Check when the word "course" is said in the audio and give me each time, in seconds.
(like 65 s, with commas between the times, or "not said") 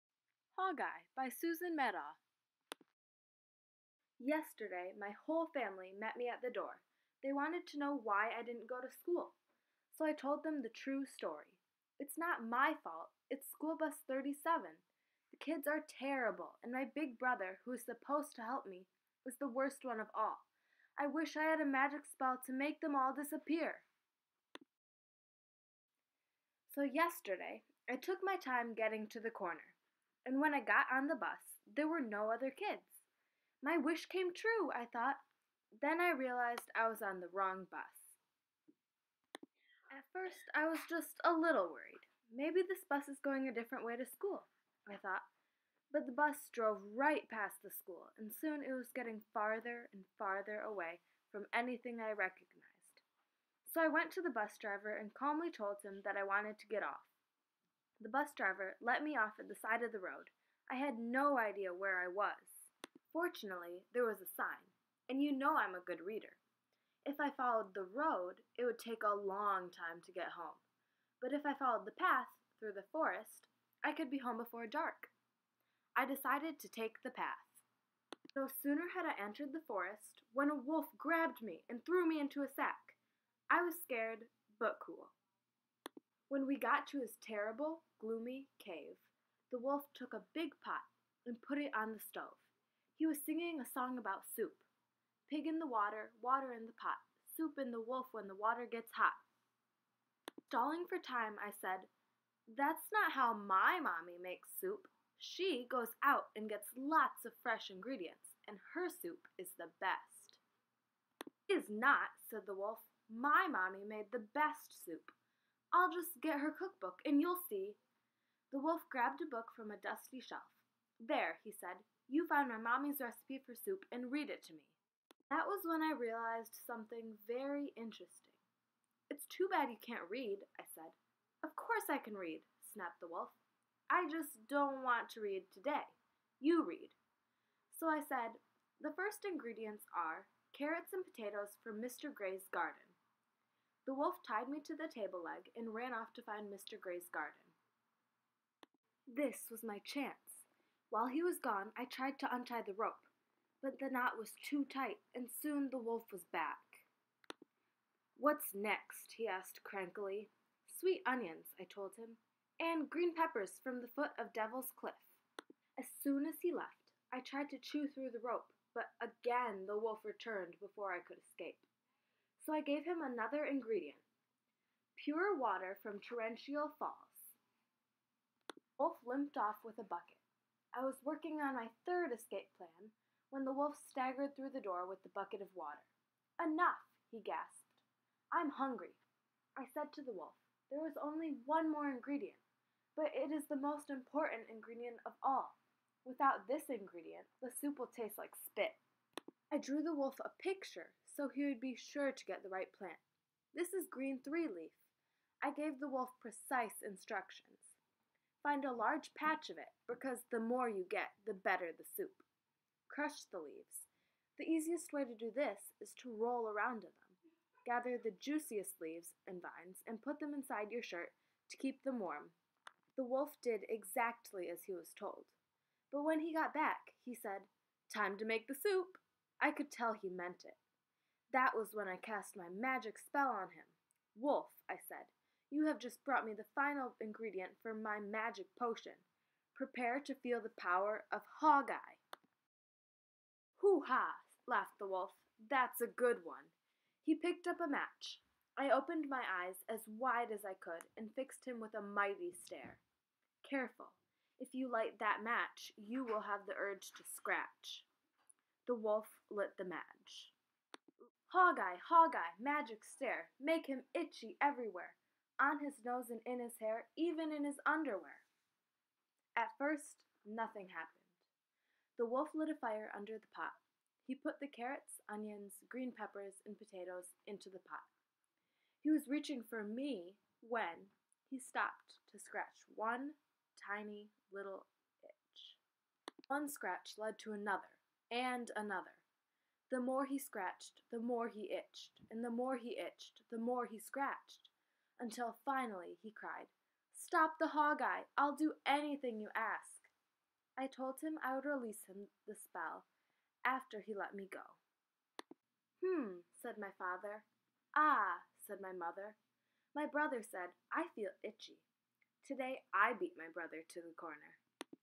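131 s.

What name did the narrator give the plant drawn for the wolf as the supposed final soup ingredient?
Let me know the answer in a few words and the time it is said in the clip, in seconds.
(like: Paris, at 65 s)
green three leaf, at 203 s.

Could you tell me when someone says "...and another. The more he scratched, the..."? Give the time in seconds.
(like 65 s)
288 s.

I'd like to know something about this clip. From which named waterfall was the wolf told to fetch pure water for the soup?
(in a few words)
Torrential Falls.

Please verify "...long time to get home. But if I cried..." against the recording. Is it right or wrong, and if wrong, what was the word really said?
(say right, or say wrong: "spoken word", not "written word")
wrong: "followed", not "cried".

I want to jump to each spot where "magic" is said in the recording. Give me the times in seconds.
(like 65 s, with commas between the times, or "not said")
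21 s, 232 s, 237 s, 262 s.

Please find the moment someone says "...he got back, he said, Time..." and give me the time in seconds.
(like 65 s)
226 s.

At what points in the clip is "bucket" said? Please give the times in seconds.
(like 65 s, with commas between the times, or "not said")
179 s, 185 s.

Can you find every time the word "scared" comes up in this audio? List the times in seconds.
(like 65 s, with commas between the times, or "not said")
83 s.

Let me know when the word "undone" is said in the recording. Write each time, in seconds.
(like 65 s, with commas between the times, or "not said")
not said.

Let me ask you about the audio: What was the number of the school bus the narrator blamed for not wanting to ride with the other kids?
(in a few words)
37.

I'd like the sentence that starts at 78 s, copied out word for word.
No sooner had I entered the forest when a wolf grabbed me and threw me into a sack.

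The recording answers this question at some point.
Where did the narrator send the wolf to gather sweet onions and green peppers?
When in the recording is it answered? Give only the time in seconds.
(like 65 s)
164 s.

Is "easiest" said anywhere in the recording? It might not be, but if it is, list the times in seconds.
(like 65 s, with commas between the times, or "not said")
214 s.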